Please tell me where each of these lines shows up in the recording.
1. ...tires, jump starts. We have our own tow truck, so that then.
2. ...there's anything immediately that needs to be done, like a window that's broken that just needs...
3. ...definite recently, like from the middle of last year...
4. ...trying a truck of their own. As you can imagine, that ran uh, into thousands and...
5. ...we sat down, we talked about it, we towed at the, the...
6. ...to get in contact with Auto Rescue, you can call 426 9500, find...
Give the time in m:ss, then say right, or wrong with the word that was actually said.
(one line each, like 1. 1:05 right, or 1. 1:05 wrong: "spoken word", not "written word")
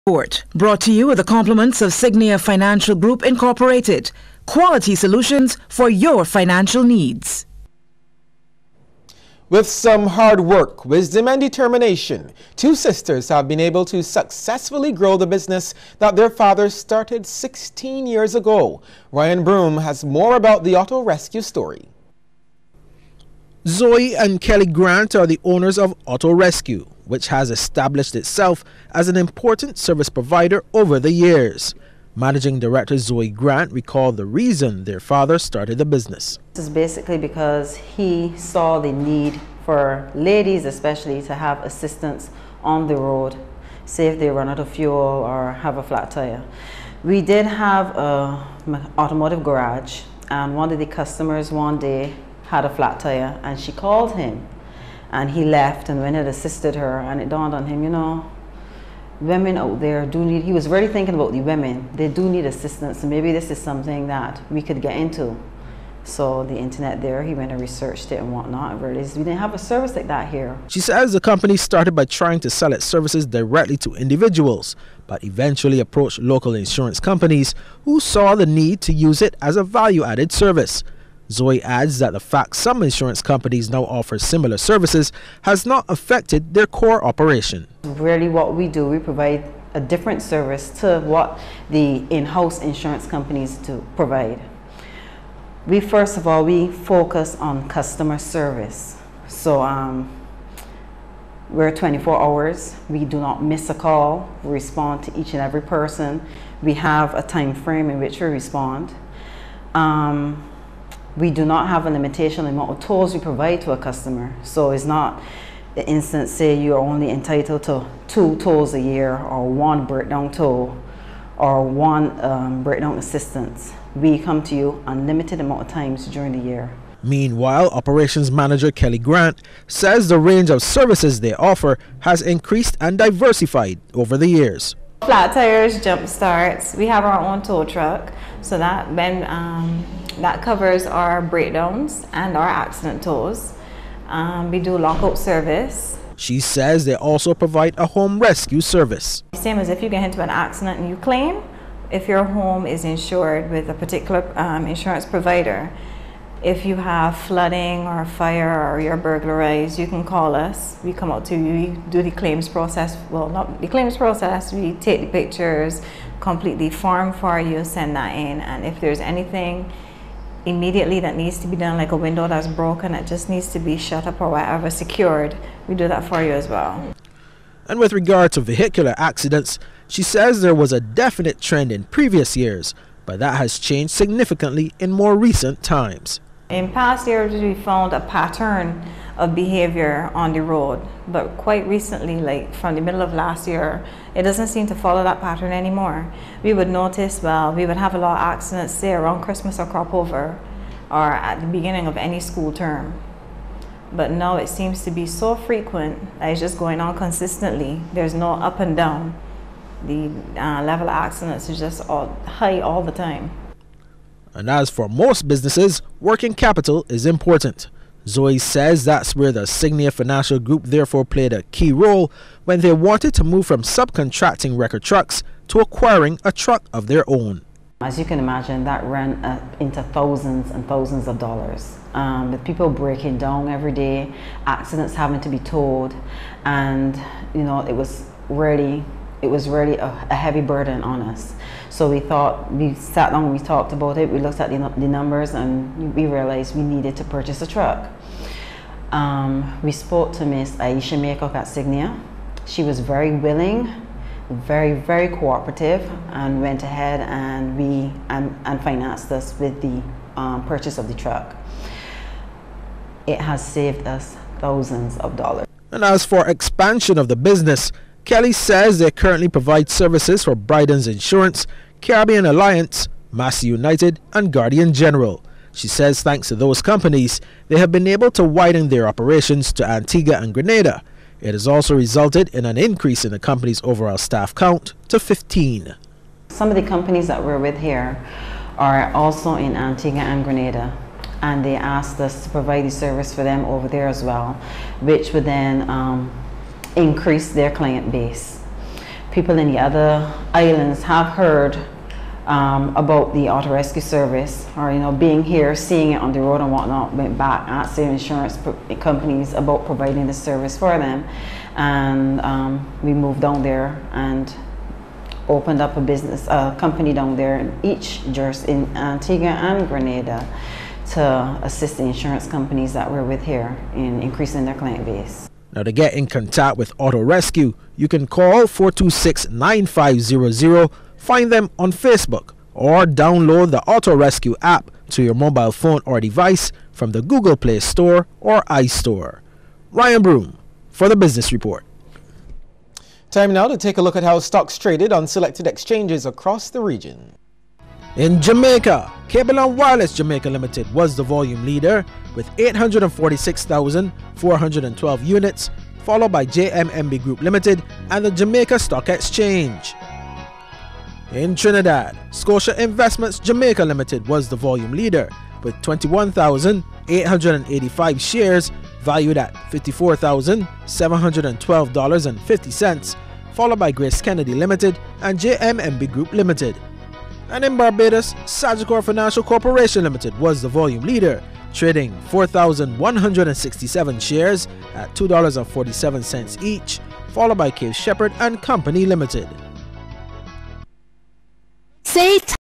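1. 2:15 right
2. 2:48 right
3. 3:11 wrong: "quite", not "definite"
4. 3:45 wrong: "acquiring", not "trying"
5. 4:02 wrong: "looked", not "towed"
6. 5:25 right.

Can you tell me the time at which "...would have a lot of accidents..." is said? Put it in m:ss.
3:17.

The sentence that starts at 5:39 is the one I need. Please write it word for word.
Ryan Broom for the Business Report.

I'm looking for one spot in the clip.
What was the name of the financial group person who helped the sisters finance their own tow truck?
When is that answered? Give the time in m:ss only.
4:10.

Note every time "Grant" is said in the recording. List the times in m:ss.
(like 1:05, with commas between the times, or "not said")
0:24, 0:33, 2:08.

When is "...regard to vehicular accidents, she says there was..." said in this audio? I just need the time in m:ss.
2:57.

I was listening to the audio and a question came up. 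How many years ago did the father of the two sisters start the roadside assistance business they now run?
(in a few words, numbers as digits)
16.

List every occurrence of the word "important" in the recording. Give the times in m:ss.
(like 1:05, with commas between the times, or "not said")
0:29, 3:37.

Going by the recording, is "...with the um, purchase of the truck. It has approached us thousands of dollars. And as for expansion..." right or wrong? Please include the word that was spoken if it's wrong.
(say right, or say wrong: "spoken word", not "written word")
wrong: "saved", not "approached".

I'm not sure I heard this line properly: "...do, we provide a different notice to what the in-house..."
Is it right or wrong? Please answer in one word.
wrong.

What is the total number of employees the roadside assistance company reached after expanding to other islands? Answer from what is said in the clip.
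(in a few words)
15.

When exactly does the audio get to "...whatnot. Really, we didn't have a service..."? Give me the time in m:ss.
1:08.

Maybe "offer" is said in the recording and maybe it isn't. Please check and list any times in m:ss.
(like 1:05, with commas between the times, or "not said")
1:23, 2:11.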